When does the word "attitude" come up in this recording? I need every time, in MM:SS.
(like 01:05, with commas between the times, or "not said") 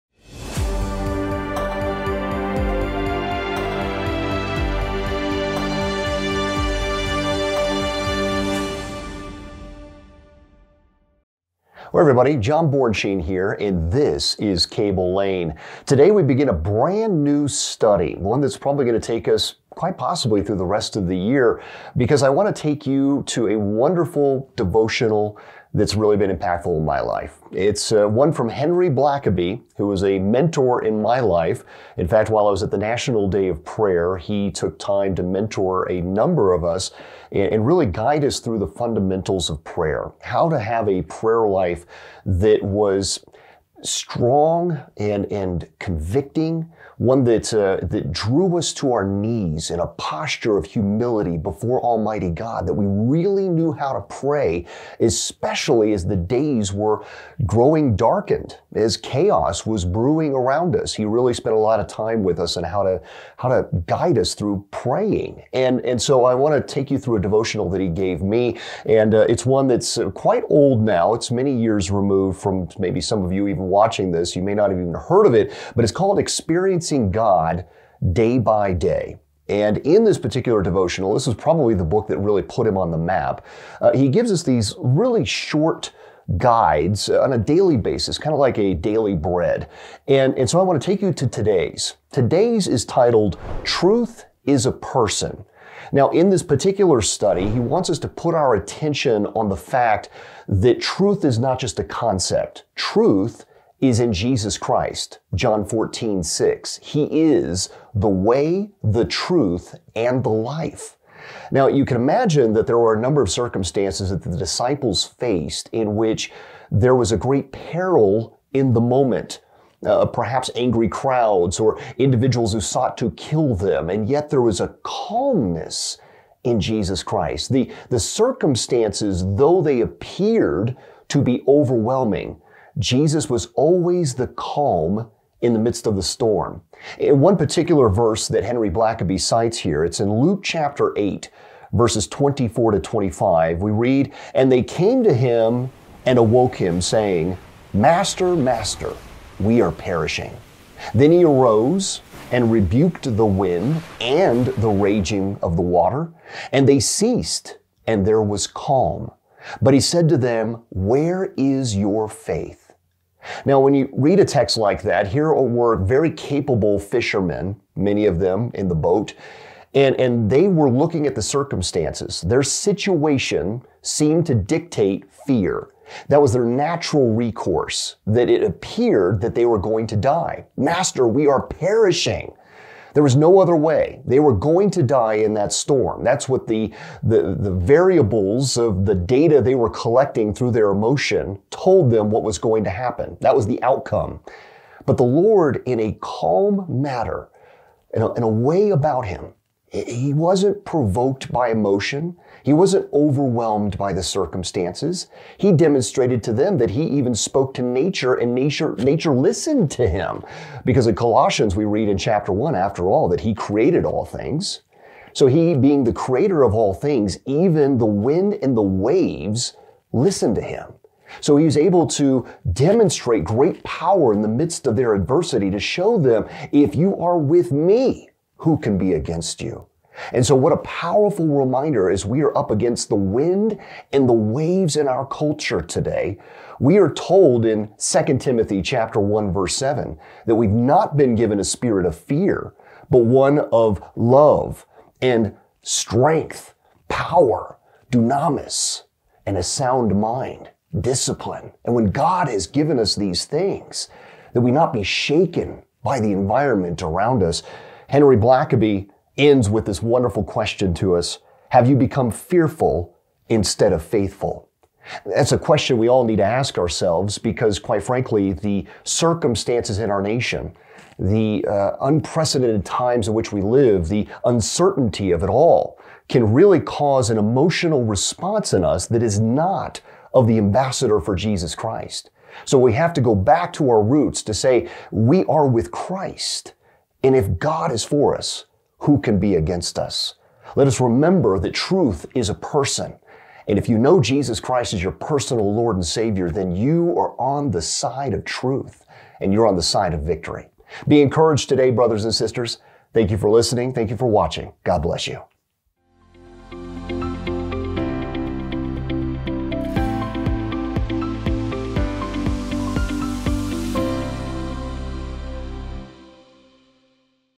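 not said.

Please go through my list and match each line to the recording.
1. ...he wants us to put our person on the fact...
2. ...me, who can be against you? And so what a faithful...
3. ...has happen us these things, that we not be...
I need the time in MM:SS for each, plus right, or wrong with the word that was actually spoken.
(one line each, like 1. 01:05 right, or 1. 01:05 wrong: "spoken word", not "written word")
1. 01:37 wrong: "attention", not "person"
2. 03:47 wrong: "powerful", not "faithful"
3. 04:12 wrong: "given", not "happen".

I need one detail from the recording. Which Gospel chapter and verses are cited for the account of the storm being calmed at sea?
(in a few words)
Luke 8:24-25.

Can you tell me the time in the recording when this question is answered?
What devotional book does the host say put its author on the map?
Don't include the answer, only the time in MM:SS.
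01:16.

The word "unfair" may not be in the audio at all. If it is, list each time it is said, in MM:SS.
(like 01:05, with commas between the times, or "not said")
not said.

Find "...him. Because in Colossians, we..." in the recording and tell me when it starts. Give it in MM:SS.
03:29.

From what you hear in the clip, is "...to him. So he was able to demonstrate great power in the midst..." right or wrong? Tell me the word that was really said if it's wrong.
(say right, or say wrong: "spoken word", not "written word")
right.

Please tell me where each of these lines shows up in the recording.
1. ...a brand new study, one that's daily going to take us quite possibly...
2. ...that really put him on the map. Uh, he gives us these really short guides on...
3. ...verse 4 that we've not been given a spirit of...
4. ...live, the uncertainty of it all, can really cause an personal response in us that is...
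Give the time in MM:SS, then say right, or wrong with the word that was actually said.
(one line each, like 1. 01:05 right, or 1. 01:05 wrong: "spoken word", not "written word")
1. 00:16 wrong: "probably", not "daily"
2. 01:22 right
3. 03:59 wrong: "7", not "4"
4. 04:33 wrong: "emotional", not "personal".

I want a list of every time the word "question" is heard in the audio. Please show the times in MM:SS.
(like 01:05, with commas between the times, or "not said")
04:20, 04:25.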